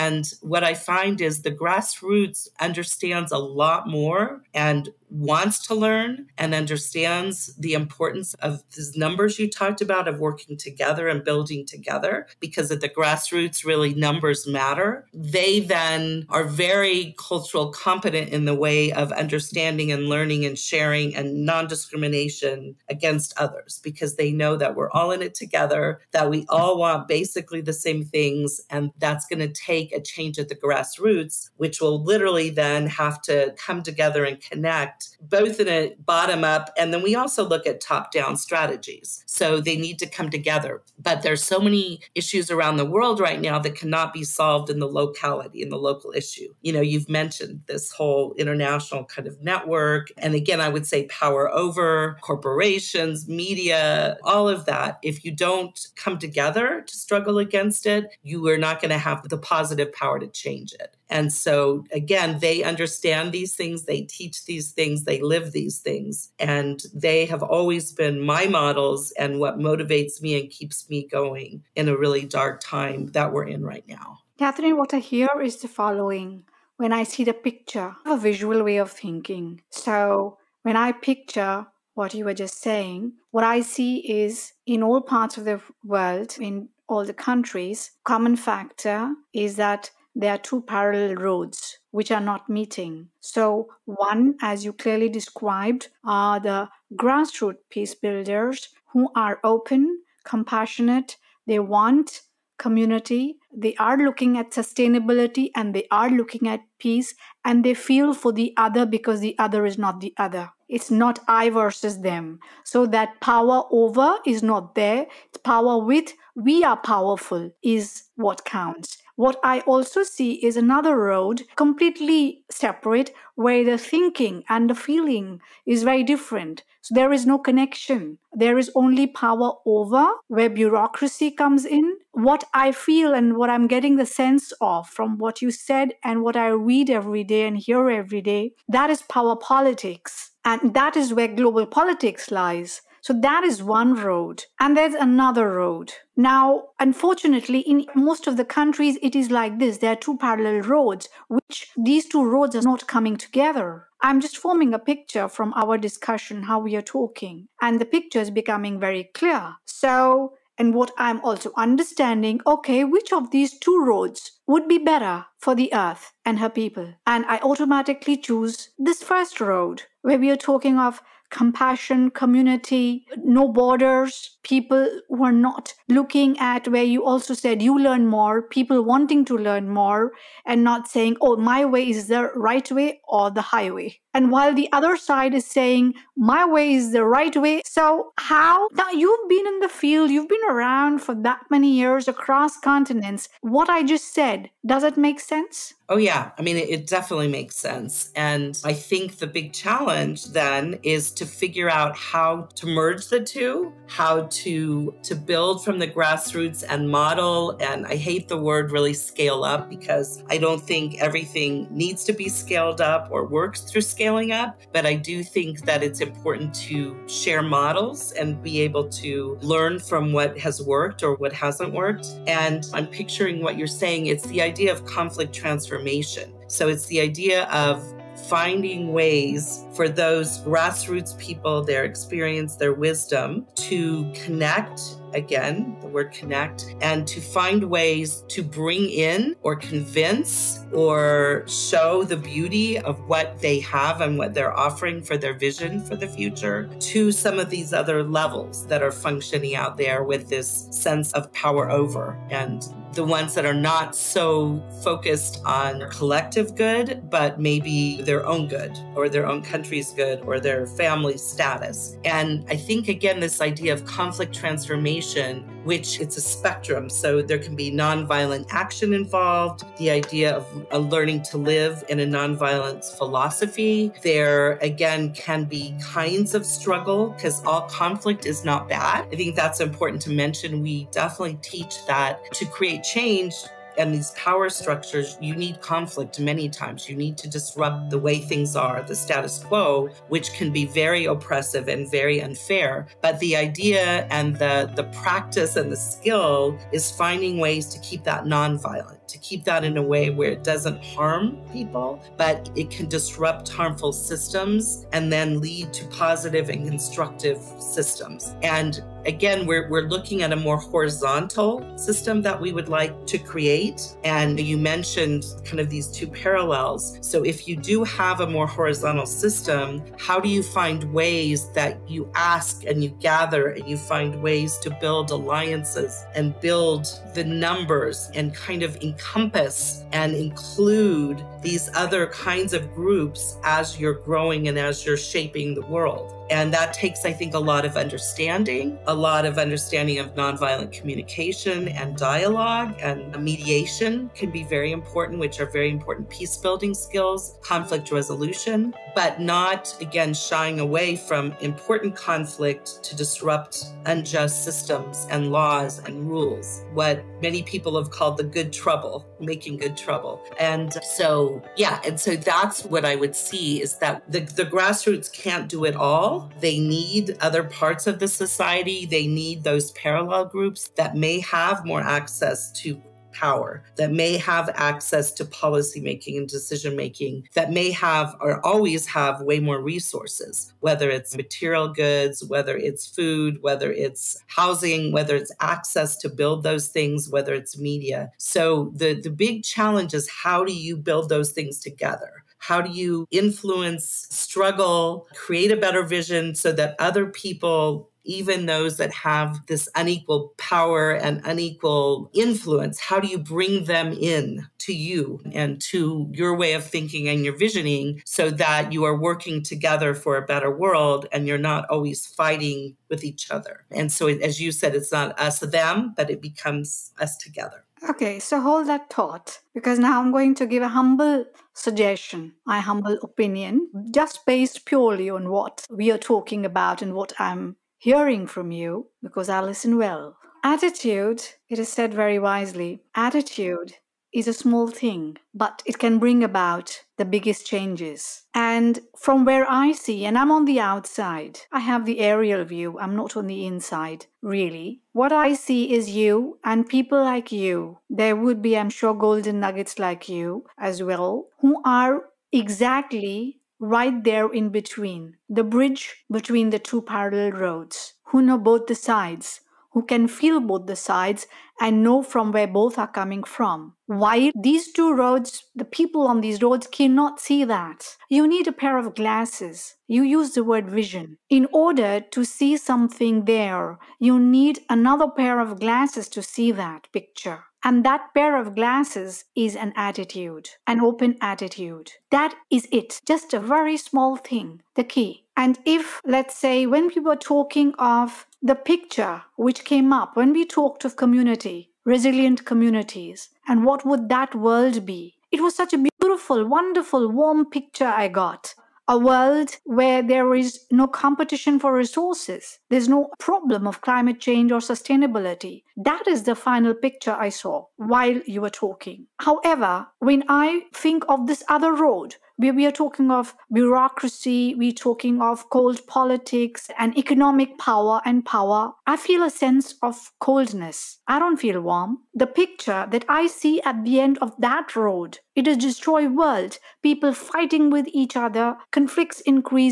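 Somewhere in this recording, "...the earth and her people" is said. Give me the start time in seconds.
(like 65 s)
165 s.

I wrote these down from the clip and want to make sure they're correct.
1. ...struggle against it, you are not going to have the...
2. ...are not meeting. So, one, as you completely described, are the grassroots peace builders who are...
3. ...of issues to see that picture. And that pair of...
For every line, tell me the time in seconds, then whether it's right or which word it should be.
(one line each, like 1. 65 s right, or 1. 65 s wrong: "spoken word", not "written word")
1. 56 s right
2. 92 s wrong: "clearly", not "completely"
3. 475 s wrong: "glasses", not "issues".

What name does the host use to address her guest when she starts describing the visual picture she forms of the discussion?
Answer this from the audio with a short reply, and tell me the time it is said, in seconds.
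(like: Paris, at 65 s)
Katherine, at 74 s.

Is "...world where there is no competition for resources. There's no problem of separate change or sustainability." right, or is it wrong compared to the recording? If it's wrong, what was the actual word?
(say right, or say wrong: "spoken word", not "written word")
wrong: "climate", not "separate".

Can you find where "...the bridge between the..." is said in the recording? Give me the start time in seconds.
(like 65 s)
455 s.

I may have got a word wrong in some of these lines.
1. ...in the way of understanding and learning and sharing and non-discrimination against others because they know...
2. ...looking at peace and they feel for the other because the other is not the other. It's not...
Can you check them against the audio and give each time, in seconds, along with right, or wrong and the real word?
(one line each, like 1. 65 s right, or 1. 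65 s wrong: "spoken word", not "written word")
1. 18 s right
2. 106 s right.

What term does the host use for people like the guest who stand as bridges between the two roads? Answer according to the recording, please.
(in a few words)
golden nuggets.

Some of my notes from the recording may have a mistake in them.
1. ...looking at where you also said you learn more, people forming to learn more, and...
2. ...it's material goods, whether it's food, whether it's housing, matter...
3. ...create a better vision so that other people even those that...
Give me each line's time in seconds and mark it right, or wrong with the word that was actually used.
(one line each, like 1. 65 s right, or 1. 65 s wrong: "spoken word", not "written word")
1. 175 s wrong: "wanting", not "forming"
2. 380 s wrong: "whether", not "matter"
3. 395 s right.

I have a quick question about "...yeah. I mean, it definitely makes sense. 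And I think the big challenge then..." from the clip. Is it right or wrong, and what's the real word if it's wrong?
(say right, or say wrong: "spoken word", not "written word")
right.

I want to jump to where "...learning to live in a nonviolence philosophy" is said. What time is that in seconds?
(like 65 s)
270 s.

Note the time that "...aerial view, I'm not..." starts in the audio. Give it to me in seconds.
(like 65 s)
441 s.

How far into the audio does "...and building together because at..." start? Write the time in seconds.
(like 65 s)
11 s.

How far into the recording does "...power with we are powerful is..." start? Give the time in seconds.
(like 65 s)
115 s.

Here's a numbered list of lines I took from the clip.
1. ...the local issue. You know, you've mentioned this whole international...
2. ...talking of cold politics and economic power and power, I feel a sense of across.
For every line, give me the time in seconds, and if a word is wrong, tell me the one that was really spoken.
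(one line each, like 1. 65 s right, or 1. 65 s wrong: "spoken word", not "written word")
1. 45 s right
2. 514 s wrong: "coldness", not "across".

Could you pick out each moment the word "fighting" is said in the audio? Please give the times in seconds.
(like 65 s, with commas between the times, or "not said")
412 s, 527 s.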